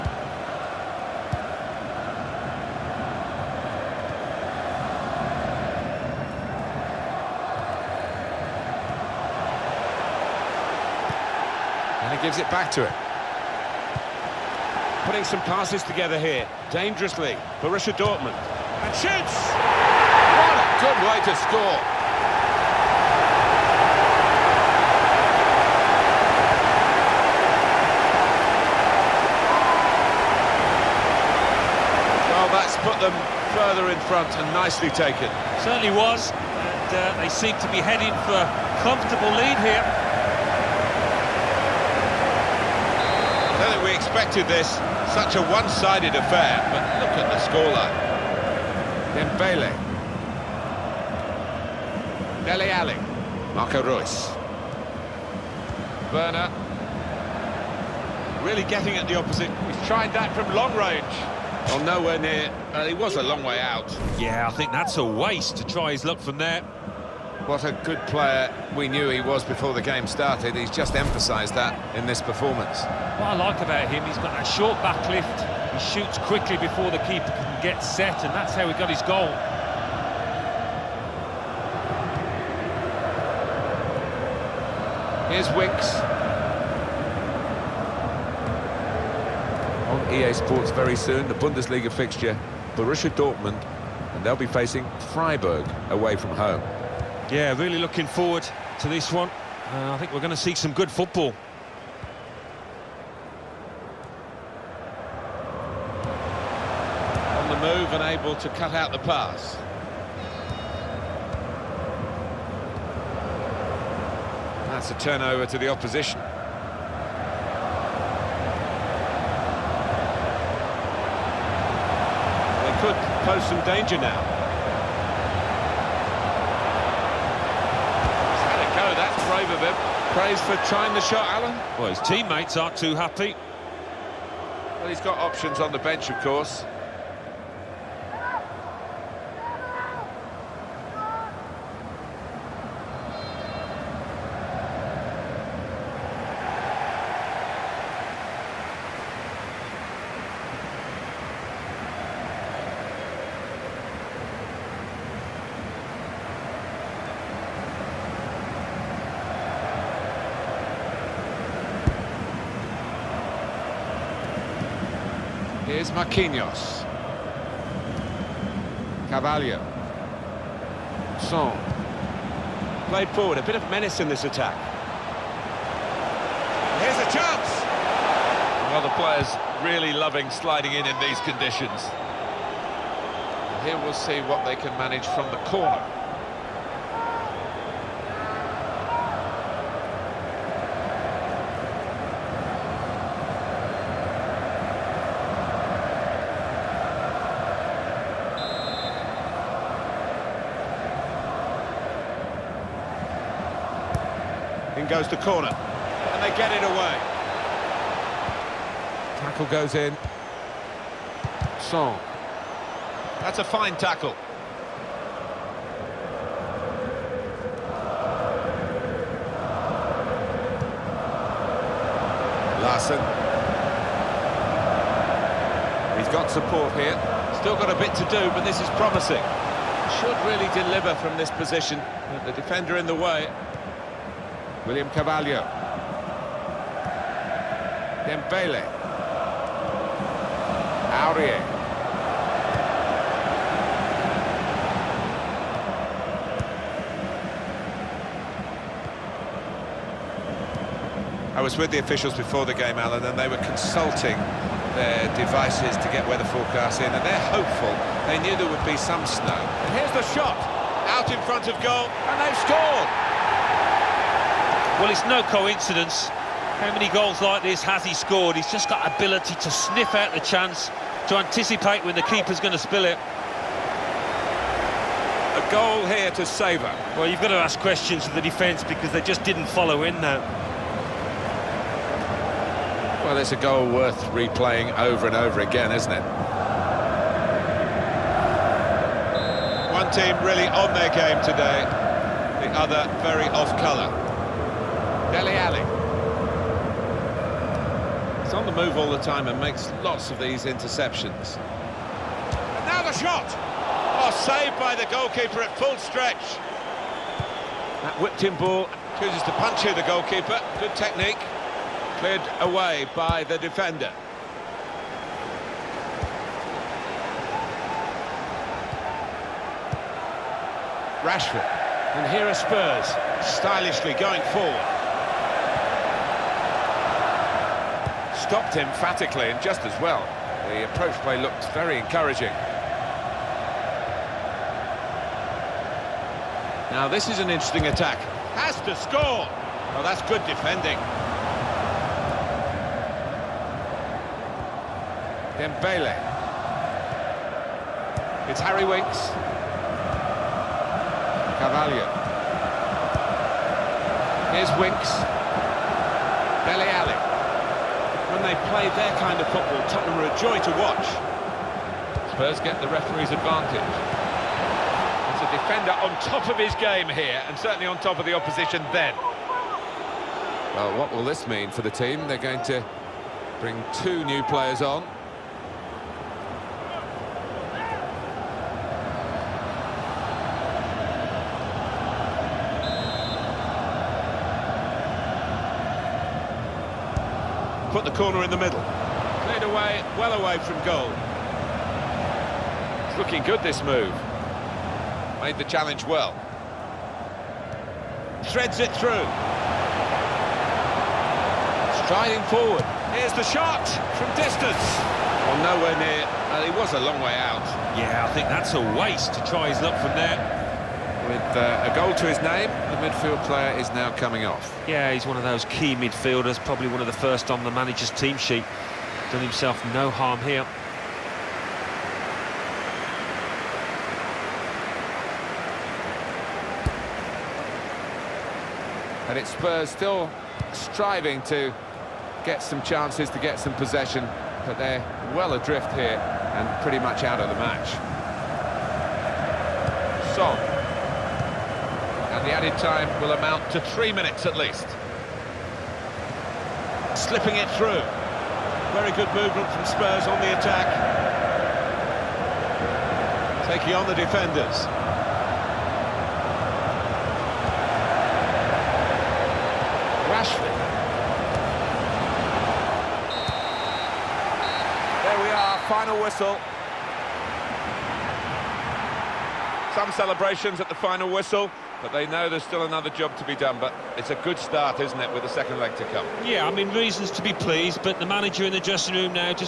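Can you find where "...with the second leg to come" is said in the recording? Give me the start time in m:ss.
7:55.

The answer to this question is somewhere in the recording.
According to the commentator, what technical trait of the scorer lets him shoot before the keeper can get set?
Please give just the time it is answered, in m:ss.
1:14.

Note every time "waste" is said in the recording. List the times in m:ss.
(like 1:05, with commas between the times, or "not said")
1:05, 6:48.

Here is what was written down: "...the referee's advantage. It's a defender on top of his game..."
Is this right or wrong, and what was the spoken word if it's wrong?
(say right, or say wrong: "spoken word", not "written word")
right.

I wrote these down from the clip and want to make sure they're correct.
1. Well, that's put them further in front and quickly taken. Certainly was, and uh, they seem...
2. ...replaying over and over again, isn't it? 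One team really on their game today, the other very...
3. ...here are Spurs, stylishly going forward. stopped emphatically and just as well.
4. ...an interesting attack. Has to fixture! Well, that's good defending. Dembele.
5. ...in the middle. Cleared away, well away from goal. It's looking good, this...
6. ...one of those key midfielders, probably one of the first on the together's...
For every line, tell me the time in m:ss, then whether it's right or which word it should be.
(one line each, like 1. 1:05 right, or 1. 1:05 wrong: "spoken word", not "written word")
1. 0:32 wrong: "nicely", not "quickly"
2. 4:44 right
3. 5:22 right
4. 5:37 wrong: "score", not "fixture"
5. 6:28 right
6. 6:55 wrong: "manager", not "together".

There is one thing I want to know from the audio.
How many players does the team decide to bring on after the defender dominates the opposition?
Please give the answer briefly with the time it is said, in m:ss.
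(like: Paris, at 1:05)
2, at 6:13.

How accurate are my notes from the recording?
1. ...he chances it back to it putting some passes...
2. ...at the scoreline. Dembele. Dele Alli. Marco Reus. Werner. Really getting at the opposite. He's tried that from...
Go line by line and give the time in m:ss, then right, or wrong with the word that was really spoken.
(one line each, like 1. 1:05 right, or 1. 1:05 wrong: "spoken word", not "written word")
1. 0:12 wrong: "gives", not "chances"
2. 0:47 right.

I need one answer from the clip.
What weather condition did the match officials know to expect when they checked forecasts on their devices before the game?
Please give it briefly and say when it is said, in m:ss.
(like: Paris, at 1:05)
Snow, at 4:19.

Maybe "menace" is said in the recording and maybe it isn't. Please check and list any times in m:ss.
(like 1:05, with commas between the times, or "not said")
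2:53.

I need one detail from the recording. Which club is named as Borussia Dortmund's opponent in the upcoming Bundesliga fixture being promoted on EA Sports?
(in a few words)
Freiburg.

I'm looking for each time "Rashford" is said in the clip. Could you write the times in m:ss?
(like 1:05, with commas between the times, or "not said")
5:21, 7:40.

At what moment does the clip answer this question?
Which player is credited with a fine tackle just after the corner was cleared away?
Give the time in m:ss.
3:31.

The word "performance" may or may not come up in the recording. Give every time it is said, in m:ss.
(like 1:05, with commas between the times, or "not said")
1:12.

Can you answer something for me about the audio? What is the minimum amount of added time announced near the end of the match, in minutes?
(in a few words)
3.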